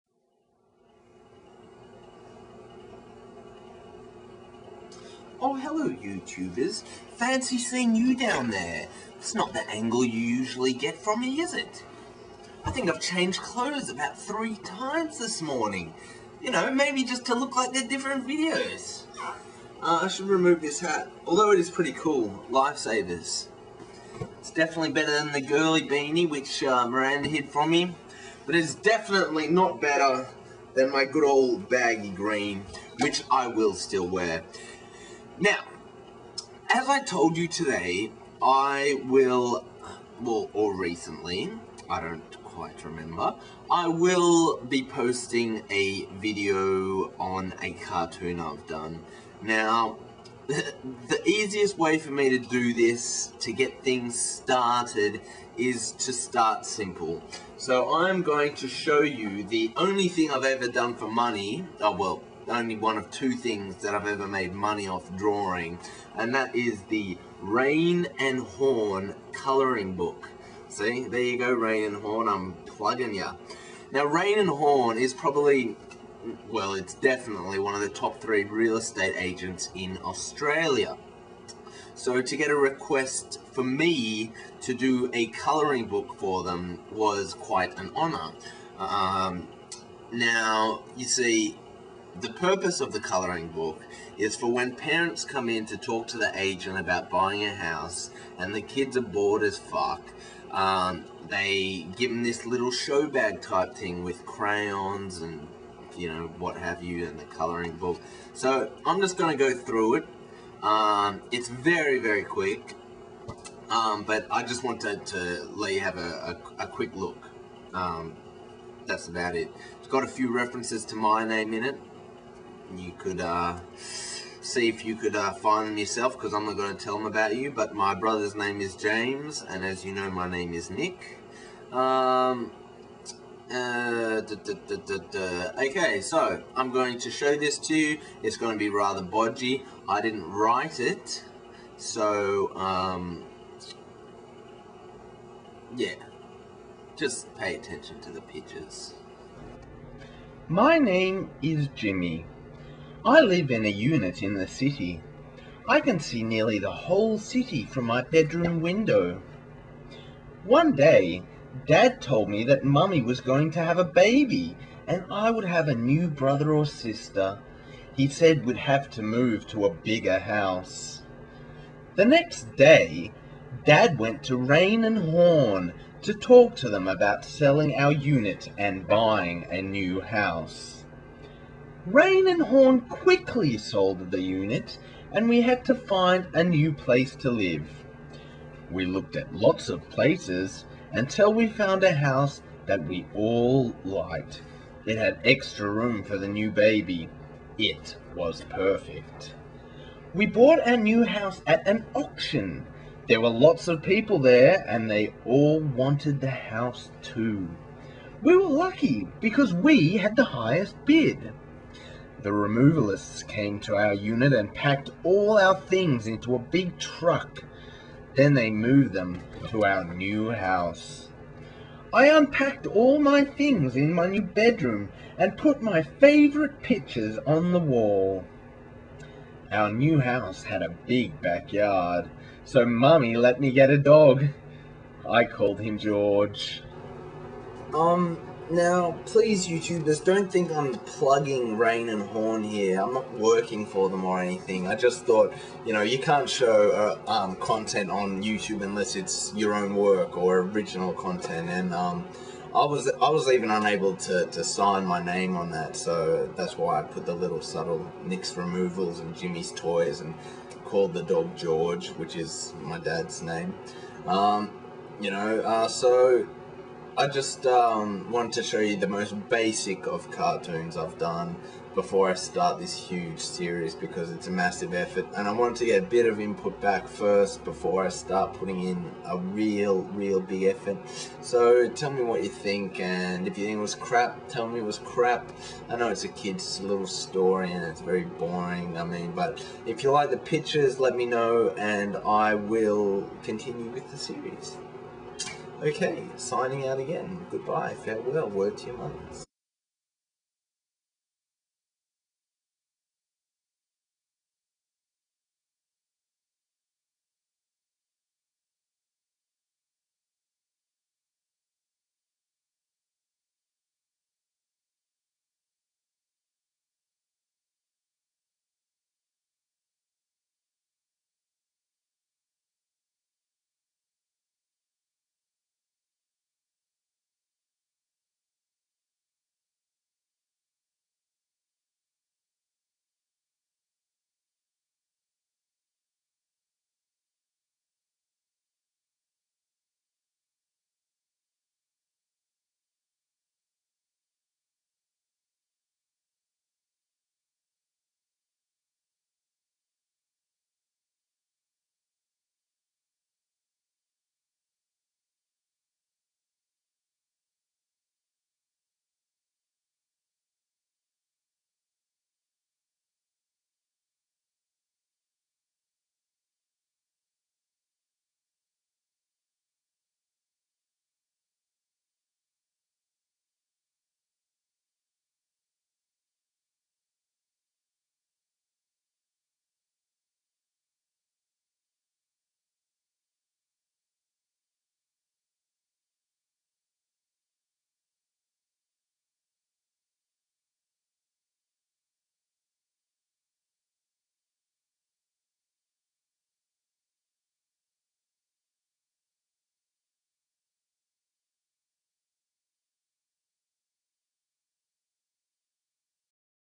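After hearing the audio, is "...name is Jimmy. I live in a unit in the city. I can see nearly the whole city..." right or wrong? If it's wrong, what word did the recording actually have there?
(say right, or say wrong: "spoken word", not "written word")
right.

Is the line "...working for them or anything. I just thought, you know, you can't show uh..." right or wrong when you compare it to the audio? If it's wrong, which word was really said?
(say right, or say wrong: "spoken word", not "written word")
right.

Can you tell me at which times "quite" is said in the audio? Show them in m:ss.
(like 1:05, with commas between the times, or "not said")
0:42, 1:27.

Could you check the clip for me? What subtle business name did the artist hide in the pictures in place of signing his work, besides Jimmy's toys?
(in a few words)
Nick's removals.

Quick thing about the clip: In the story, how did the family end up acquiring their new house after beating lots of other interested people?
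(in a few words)
At an auction.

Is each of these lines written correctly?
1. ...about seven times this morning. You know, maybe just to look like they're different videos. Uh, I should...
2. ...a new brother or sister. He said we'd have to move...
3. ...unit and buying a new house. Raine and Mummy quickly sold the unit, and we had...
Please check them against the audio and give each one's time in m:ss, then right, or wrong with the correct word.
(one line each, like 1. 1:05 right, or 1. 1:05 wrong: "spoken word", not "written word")
1. 0:13 wrong: "three", not "seven"
2. 2:45 right
3. 2:57 wrong: "Horne", not "Mummy".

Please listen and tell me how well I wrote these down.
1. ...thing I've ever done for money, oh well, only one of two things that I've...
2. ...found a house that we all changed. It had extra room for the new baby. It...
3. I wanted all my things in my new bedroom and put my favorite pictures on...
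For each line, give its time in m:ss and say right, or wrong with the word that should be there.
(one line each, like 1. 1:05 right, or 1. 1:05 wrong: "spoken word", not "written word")
1. 1:00 right
2. 3:11 wrong: "liked", not "changed"
3. 3:41 wrong: "unpacked", not "wanted".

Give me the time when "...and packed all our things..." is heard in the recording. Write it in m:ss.
3:34.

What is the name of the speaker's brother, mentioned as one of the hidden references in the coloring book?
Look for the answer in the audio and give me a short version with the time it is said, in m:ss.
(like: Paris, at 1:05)
James, at 2:08.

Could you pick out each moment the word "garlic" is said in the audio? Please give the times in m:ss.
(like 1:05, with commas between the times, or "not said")
not said.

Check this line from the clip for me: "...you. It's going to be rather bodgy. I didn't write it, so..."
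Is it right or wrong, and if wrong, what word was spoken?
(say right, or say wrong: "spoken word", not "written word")
right.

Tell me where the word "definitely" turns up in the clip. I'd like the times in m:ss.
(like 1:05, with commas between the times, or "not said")
0:24, 0:28, 1:16.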